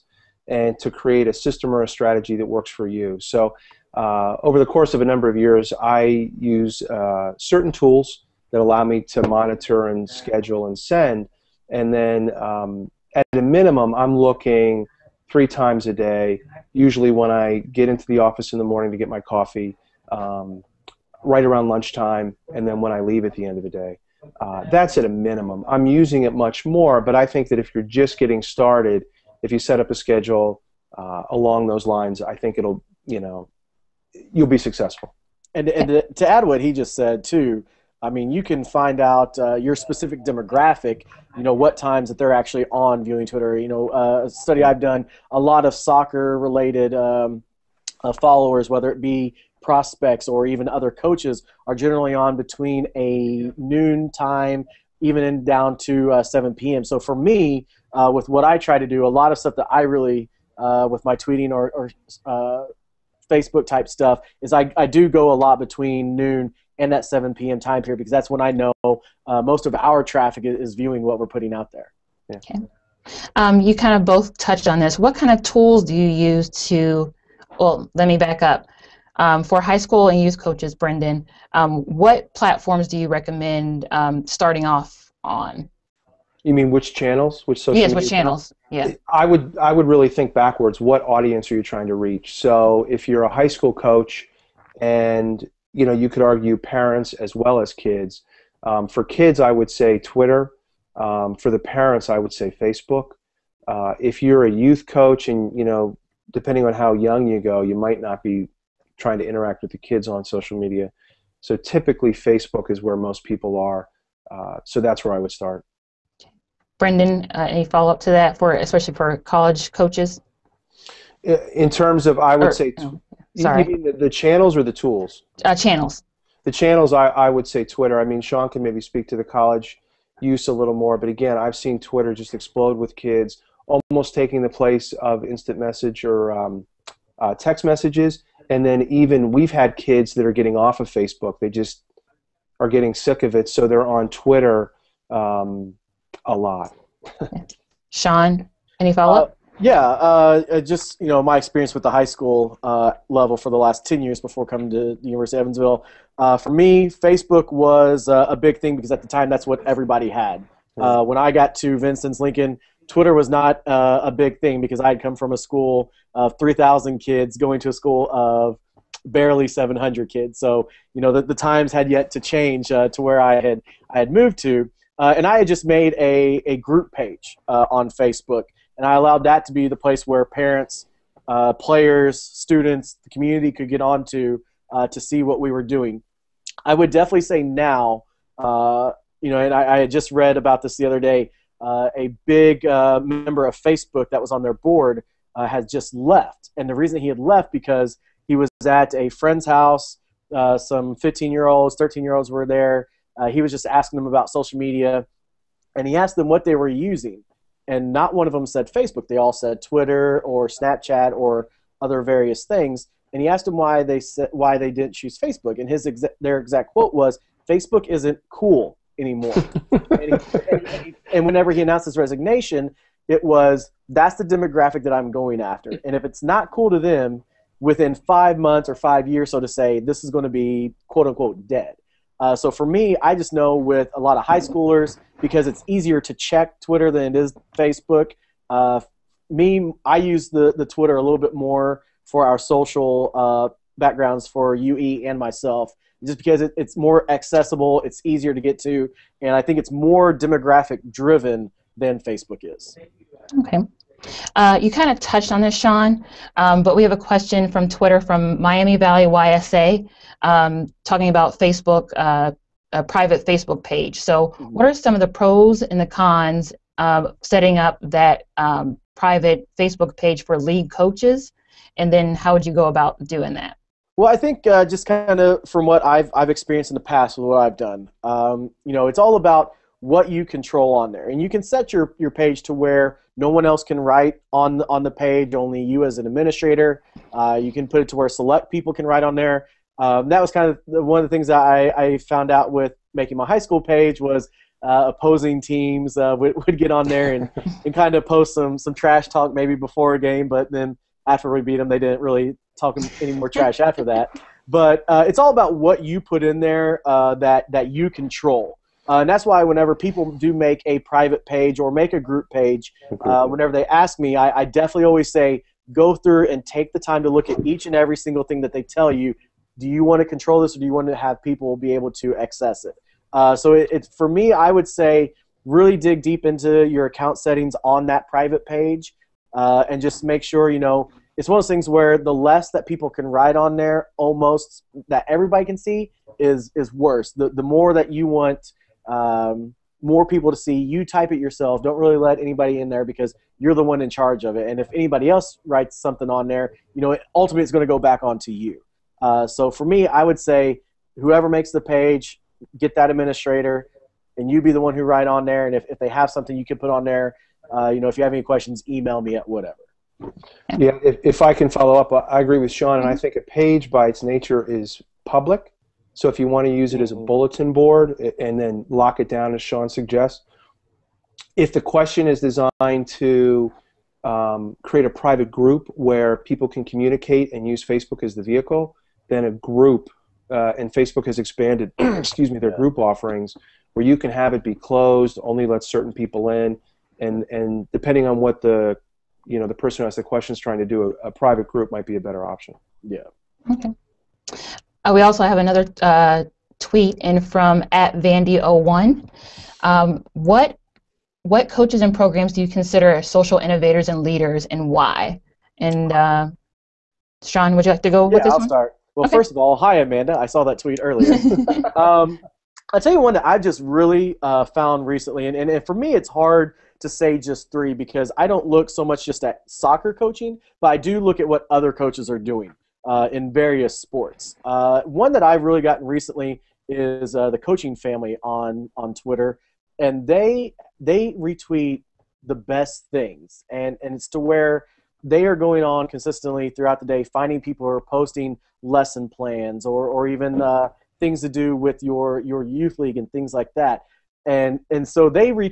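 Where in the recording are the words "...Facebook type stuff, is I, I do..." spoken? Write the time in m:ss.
1:03.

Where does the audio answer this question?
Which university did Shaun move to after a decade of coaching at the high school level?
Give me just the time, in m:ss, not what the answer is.
2:35.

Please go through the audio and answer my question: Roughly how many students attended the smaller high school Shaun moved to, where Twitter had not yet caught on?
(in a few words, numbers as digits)
700.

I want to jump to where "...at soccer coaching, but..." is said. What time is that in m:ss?
6:59.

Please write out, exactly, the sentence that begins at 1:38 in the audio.
Um, for kids, I would say Twitter.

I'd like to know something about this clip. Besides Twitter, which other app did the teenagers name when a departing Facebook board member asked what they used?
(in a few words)
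Snapchat.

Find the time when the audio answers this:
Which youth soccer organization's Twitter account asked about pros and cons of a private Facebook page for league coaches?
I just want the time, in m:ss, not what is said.
4:18.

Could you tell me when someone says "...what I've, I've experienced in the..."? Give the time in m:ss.
4:35.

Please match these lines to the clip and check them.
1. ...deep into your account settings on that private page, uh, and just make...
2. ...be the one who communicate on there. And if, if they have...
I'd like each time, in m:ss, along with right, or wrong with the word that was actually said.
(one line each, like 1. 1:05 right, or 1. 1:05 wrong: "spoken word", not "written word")
1. 5:26 right
2. 5:54 wrong: "write", not "communicate".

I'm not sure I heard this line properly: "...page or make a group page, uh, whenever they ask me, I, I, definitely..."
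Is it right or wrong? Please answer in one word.
right.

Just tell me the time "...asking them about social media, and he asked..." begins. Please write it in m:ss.
3:23.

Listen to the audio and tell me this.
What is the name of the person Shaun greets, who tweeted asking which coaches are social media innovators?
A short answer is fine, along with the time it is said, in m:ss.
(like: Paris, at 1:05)
Amanda, at 6:49.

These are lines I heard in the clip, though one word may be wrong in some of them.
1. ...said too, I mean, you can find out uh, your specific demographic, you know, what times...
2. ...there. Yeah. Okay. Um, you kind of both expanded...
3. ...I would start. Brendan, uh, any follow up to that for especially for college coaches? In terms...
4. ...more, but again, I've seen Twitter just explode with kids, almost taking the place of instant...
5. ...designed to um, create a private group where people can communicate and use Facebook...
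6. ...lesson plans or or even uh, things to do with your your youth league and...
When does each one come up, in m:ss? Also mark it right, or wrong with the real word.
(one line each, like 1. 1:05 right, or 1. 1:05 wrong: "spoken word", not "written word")
1. 0:36 right
2. 1:11 wrong: "touched", not "expanded"
3. 1:55 right
4. 2:10 right
5. 6:12 right
6. 7:18 right.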